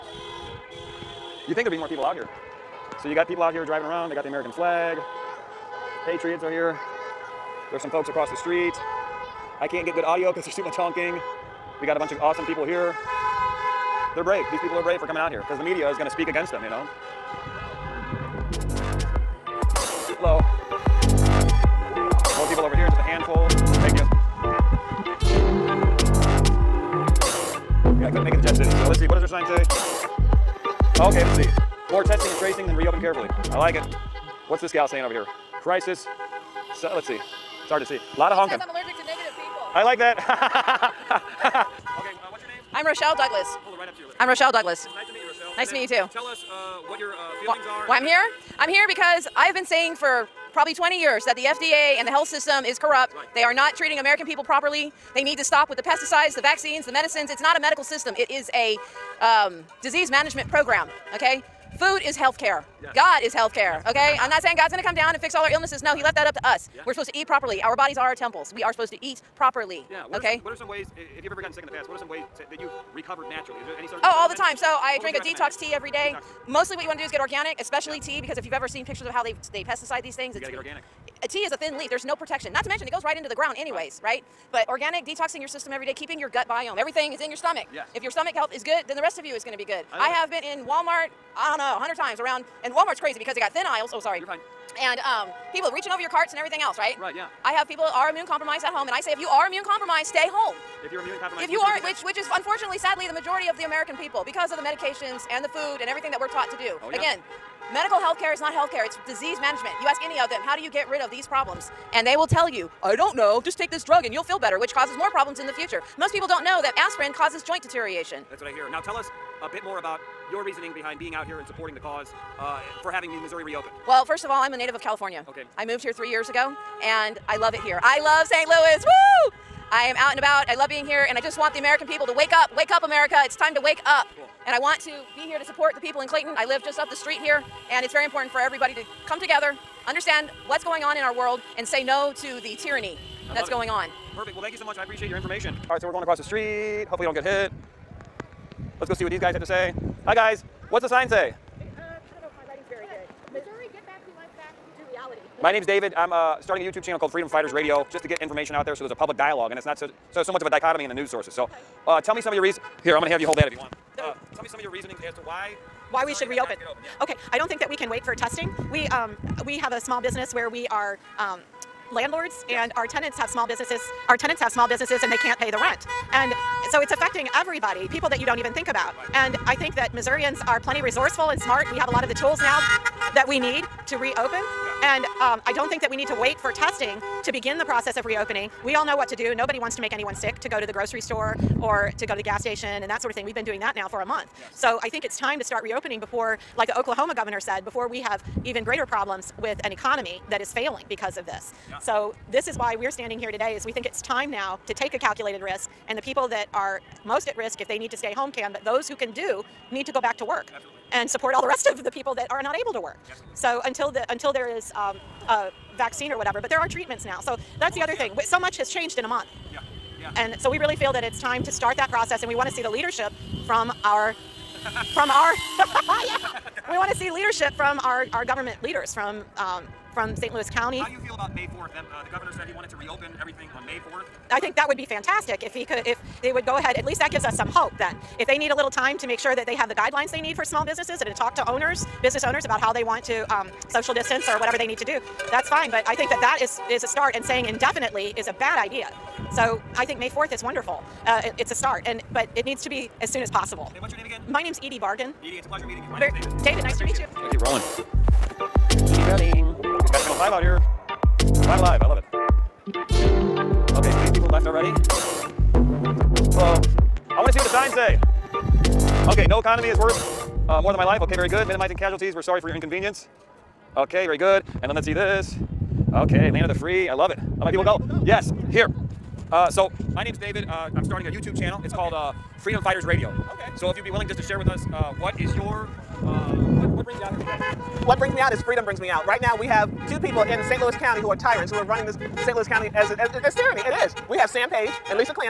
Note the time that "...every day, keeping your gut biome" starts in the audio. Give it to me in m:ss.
1:25.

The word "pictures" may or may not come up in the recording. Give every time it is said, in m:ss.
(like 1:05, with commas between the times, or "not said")
1:18.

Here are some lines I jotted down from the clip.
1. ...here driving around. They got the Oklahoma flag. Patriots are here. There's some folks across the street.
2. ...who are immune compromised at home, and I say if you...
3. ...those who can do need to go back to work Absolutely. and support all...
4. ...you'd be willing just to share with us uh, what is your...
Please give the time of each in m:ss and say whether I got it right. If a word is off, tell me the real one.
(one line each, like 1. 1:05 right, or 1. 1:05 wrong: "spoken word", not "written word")
1. 0:03 wrong: "American", not "Oklahoma"
2. 1:37 right
3. 3:28 right
4. 4:43 right.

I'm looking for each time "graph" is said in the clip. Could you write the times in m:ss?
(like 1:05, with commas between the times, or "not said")
not said.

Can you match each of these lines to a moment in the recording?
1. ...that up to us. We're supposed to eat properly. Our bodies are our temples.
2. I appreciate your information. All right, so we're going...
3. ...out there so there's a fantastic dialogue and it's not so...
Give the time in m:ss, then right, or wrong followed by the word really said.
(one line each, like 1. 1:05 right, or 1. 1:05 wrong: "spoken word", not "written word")
1. 1:06 right
2. 2:24 right
3. 2:38 wrong: "public", not "fantastic".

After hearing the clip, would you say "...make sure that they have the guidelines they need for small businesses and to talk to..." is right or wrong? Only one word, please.
right.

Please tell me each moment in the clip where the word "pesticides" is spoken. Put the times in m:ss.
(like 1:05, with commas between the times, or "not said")
0:55, 1:19.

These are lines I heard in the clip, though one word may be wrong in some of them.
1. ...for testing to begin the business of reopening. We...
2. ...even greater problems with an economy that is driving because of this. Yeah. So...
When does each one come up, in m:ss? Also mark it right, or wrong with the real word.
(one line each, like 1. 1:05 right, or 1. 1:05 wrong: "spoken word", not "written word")
1. 3:06 wrong: "process", not "business"
2. 3:18 wrong: "failing", not "driving".